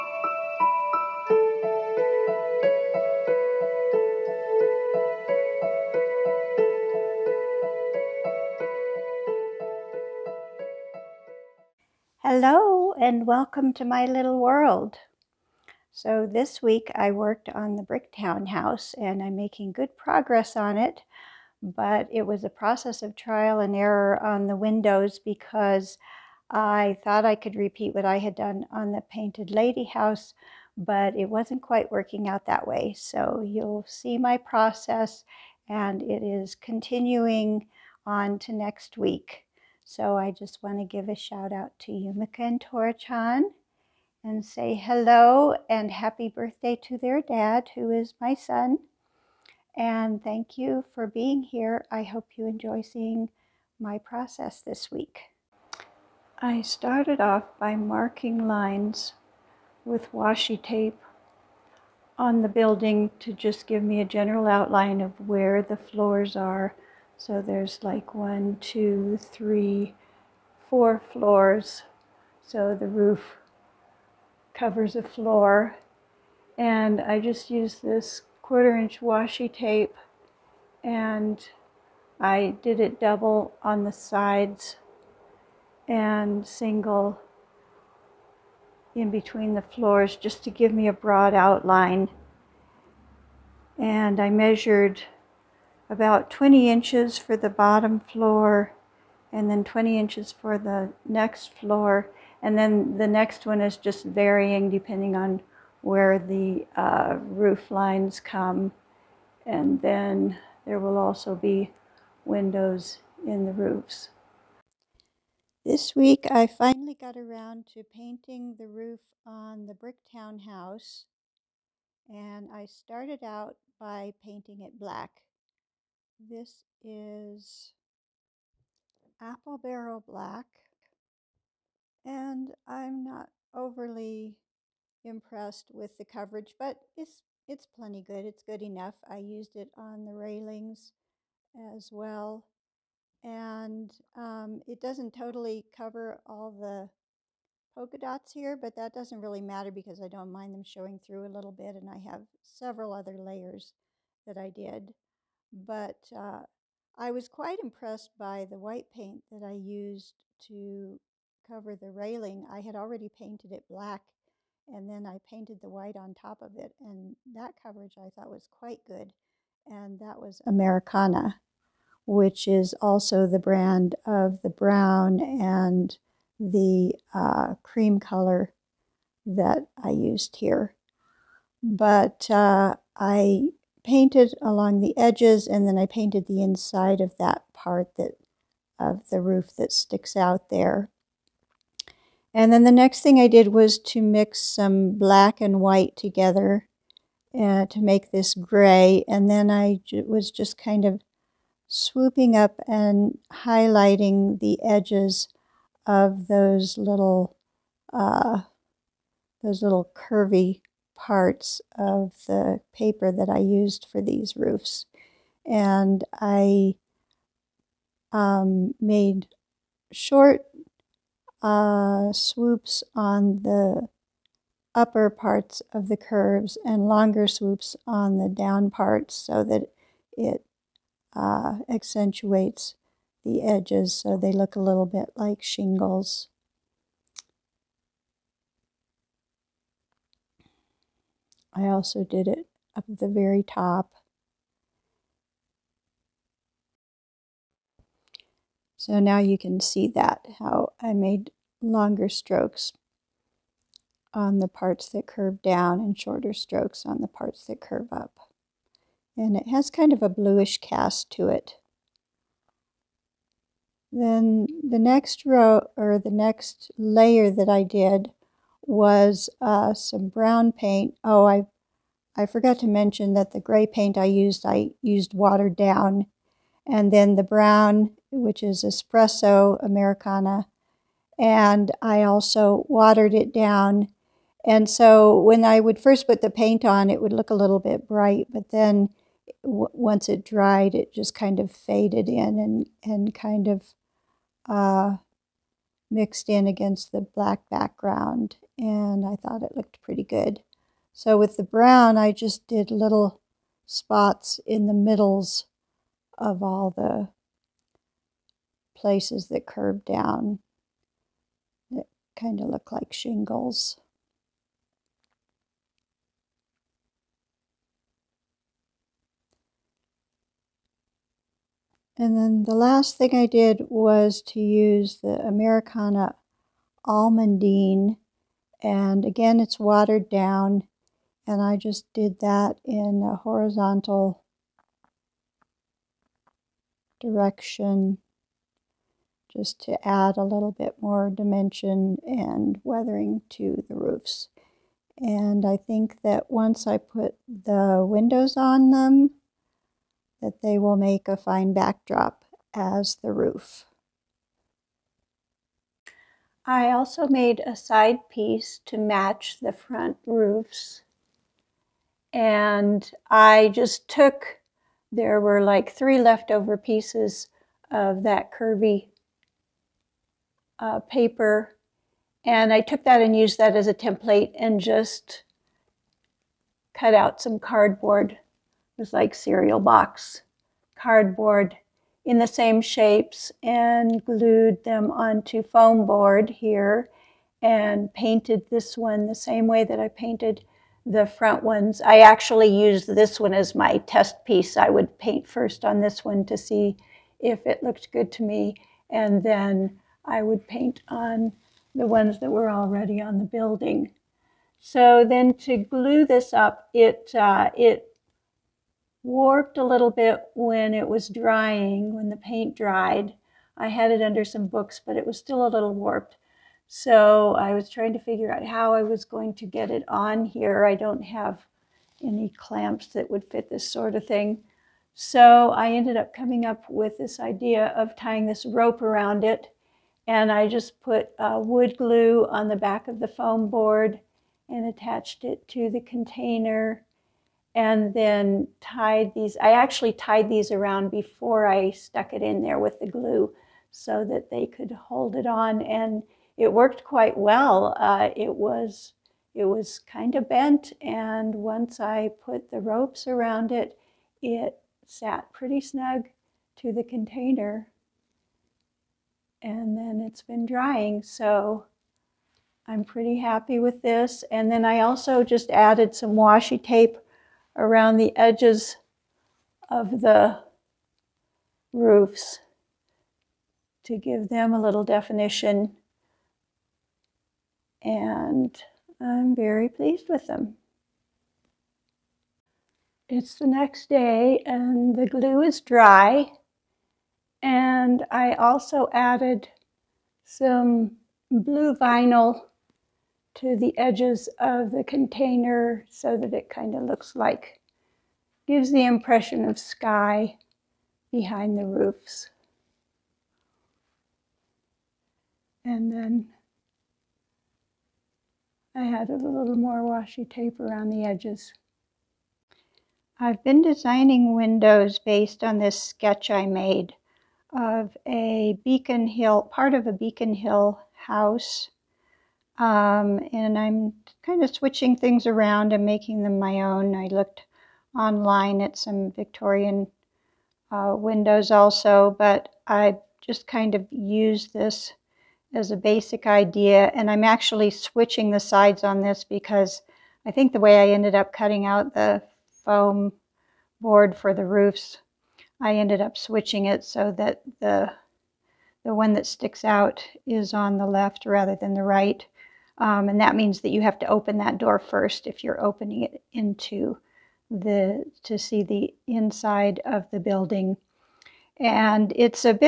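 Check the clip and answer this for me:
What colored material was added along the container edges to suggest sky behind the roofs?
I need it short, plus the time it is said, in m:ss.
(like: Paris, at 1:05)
blue vinyl, at 8:11.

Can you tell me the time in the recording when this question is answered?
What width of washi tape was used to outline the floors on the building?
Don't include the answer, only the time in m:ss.
1:18.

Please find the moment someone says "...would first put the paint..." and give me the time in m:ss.
4:45.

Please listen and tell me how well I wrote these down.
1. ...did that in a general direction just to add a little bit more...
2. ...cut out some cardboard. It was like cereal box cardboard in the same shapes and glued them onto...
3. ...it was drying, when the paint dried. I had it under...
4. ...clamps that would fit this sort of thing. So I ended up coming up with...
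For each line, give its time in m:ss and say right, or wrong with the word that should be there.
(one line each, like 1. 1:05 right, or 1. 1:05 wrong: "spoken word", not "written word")
1. 5:31 wrong: "horizontal", not "general"
2. 6:16 right
3. 6:50 right
4. 7:02 right.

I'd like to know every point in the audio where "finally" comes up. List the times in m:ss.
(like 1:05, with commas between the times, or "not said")
1:56.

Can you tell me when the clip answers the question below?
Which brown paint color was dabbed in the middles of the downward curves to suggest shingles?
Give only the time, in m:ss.
4:38.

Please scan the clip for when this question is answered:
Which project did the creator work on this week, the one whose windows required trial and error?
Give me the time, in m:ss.
0:17.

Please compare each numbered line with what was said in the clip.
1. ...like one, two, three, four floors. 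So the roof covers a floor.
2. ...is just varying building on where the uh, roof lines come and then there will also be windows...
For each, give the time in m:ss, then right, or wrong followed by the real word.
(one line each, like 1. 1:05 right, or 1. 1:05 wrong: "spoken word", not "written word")
1. 1:07 right
2. 1:43 wrong: "depending", not "building".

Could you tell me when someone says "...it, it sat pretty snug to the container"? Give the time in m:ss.
7:33.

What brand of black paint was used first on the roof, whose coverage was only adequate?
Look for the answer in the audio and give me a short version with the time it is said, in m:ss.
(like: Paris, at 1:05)
Apple Barrel, at 2:09.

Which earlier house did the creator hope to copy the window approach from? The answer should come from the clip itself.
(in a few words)
painted lady house.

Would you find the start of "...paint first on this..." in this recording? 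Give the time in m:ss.
6:34.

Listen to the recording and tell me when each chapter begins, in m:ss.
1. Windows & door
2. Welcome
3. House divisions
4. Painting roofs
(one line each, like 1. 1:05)
1. 8:31
2. 0:11
3. 0:54
4. 1:54.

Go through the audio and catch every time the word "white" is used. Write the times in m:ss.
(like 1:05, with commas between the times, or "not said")
2:38, 2:45, 3:15.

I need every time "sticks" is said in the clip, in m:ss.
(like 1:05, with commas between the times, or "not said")
3:09, 9:09.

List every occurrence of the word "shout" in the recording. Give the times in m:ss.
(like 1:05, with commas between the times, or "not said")
0:41.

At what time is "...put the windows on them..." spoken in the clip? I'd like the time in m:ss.
5:46.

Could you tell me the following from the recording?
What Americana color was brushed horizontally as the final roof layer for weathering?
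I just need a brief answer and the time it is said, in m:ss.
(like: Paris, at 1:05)
Almondine, at 5:26.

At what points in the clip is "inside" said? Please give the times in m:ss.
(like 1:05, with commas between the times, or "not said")
3:06, 9:19.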